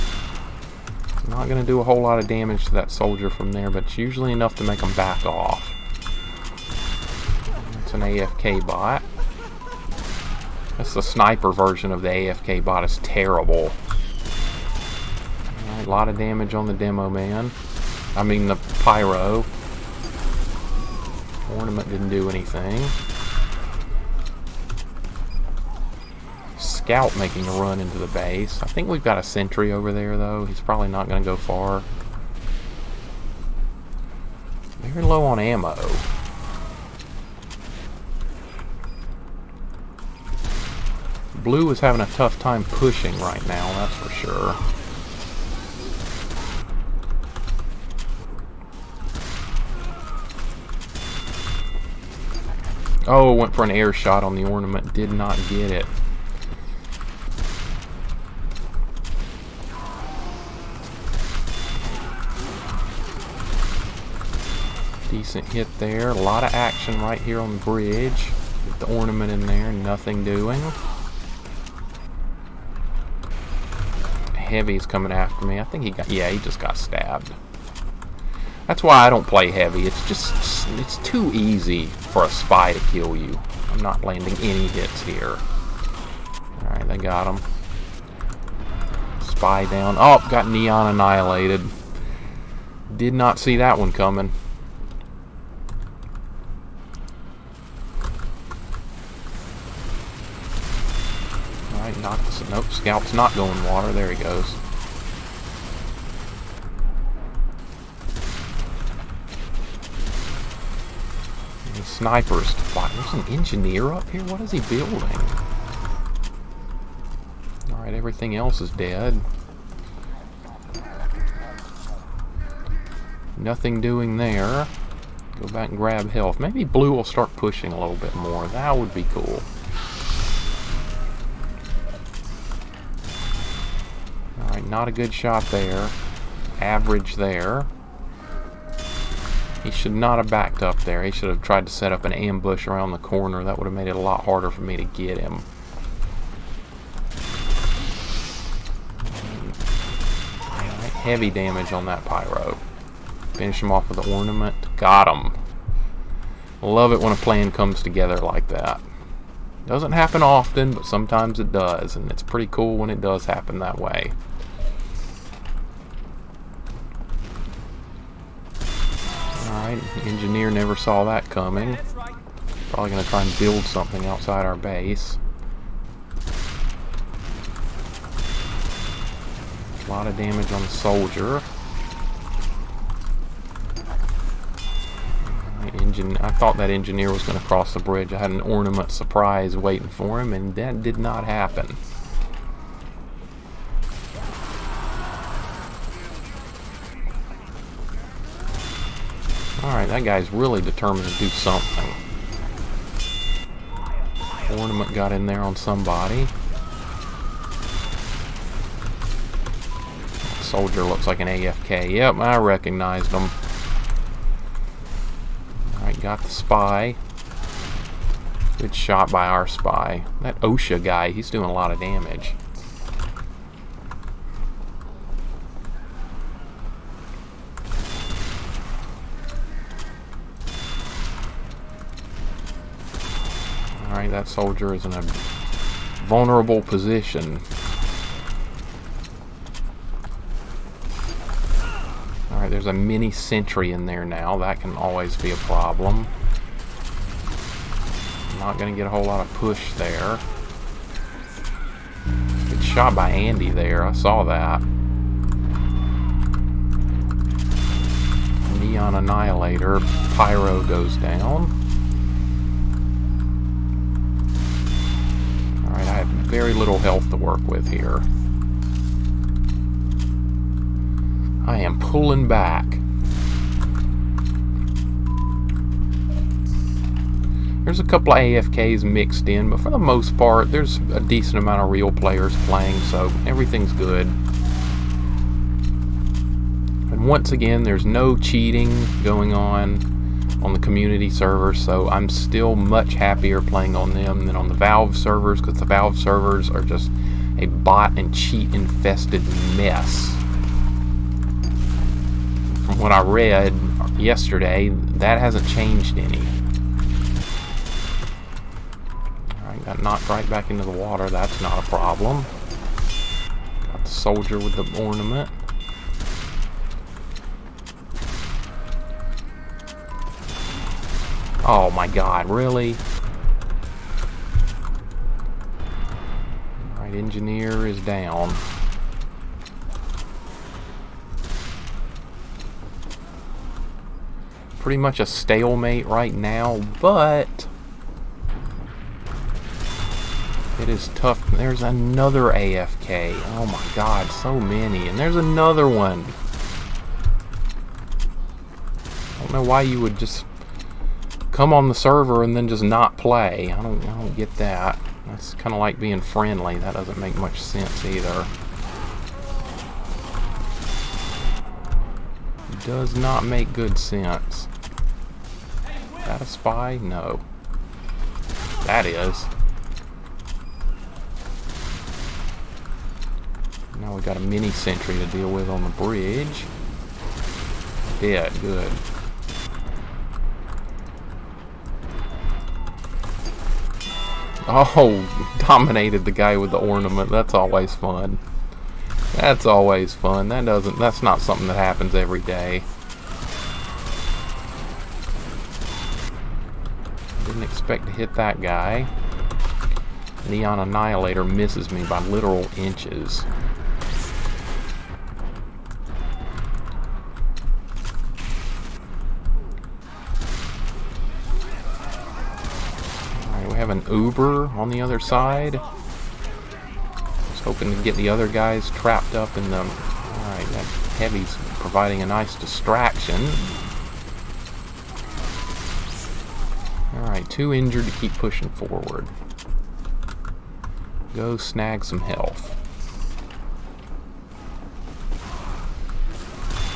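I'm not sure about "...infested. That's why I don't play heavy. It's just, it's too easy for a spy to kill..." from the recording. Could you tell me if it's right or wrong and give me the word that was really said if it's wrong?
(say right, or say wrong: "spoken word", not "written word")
wrong: "stabbed", not "infested".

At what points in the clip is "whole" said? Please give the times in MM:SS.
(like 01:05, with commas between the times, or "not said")
00:01, 04:08.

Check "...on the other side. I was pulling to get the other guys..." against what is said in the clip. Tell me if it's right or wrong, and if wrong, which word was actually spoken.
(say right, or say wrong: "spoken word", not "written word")
wrong: "hoping", not "pulling".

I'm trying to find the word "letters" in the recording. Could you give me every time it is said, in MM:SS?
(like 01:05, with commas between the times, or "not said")
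not said.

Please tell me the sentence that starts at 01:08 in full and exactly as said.
the ornament in there, nothing doing.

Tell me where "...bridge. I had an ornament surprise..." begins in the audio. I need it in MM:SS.
03:07.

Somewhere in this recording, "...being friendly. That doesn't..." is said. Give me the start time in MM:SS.
05:55.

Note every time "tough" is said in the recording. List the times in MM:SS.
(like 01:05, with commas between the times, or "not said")
00:42, 05:40.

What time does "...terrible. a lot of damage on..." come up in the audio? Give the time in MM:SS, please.
00:13.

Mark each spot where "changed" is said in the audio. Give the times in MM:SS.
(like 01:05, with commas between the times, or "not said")
05:05.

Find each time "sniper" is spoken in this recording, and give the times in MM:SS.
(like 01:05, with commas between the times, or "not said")
00:11, 01:51.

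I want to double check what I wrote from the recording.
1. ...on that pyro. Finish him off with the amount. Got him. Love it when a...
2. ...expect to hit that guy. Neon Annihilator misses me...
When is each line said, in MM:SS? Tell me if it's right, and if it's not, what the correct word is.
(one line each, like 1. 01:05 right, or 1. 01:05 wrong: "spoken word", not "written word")
1. 02:31 wrong: "ornament", not "amount"
2. 06:37 right.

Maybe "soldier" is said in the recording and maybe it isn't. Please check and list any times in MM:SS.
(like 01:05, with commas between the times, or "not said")
00:02, 03:00, 03:30, 03:54, 05:13.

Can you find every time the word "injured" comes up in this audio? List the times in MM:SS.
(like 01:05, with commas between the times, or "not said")
07:07.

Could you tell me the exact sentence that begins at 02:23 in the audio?
That would have made it a lot harder for me to get him.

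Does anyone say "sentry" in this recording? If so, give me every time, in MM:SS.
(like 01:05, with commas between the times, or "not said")
00:29, 04:03, 06:14.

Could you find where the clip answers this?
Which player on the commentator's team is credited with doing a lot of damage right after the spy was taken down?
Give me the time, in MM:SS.
03:40.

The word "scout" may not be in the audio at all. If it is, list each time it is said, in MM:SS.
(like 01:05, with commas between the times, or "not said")
00:26, 01:42.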